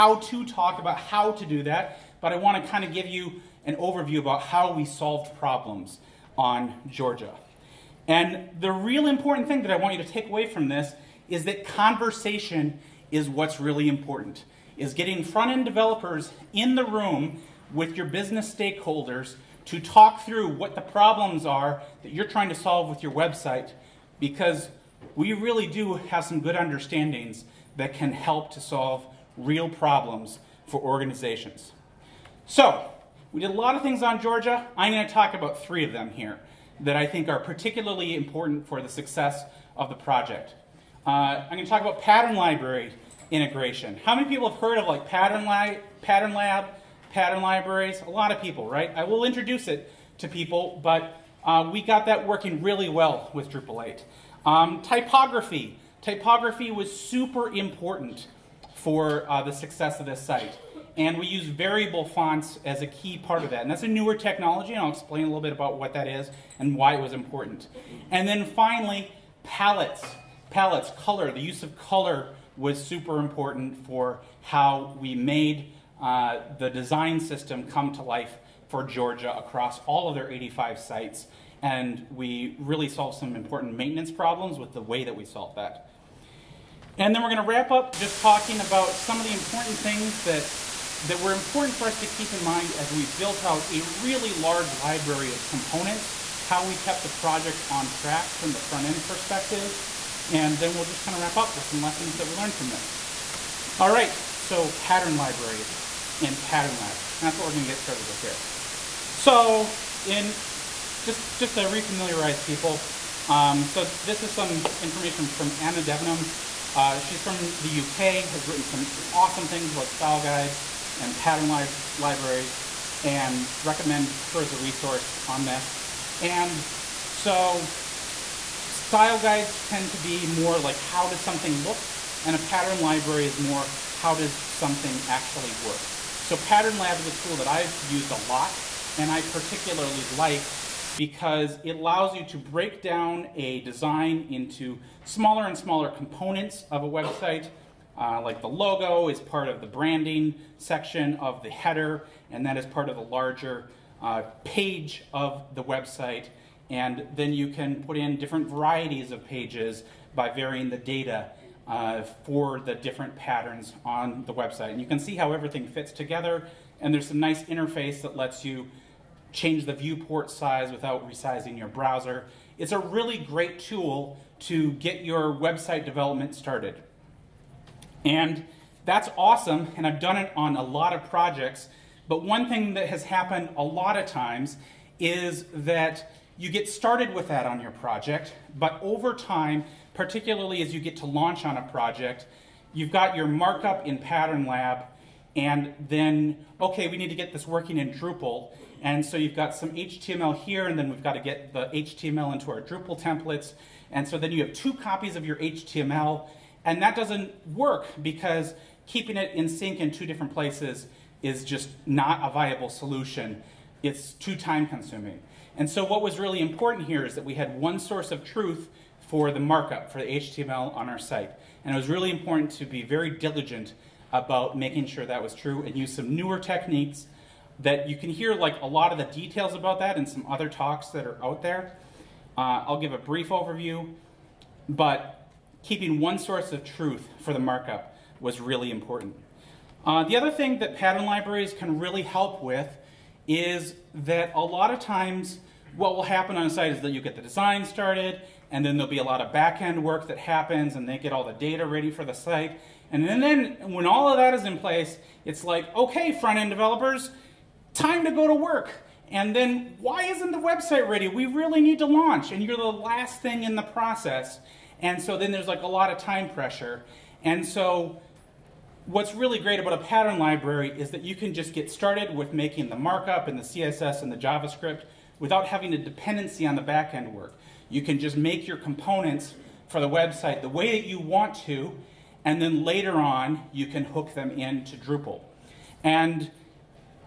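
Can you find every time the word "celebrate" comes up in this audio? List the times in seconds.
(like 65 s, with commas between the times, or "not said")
not said.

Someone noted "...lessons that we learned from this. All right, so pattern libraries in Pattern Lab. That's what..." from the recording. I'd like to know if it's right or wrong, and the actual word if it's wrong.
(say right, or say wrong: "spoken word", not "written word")
right.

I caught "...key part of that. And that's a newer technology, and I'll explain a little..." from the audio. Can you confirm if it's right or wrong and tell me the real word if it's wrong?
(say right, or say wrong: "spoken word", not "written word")
right.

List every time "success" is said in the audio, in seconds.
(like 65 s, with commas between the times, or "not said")
38 s, 59 s.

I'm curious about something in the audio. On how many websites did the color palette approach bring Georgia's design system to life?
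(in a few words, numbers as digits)
85.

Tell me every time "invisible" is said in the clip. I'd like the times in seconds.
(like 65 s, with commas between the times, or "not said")
not said.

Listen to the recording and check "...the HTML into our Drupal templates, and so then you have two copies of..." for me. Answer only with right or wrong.
right.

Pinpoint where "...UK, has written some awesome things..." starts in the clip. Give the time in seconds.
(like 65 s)
117 s.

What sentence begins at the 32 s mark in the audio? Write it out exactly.
So, we did a lot of things on Georgia.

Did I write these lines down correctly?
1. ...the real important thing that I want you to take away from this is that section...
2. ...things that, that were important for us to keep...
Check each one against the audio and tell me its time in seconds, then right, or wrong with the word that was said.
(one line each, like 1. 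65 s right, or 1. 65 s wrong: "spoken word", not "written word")
1. 8 s wrong: "conversation", not "section"
2. 89 s right.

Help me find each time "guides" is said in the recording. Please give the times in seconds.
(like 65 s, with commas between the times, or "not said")
120 s, 129 s.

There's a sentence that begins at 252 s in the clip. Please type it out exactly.
And then, then when all of that is in place, it's like, okay, front-end developers, time to go to work.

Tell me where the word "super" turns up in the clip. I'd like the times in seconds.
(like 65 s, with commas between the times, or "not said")
56 s, 72 s.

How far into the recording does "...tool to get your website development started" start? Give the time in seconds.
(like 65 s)
173 s.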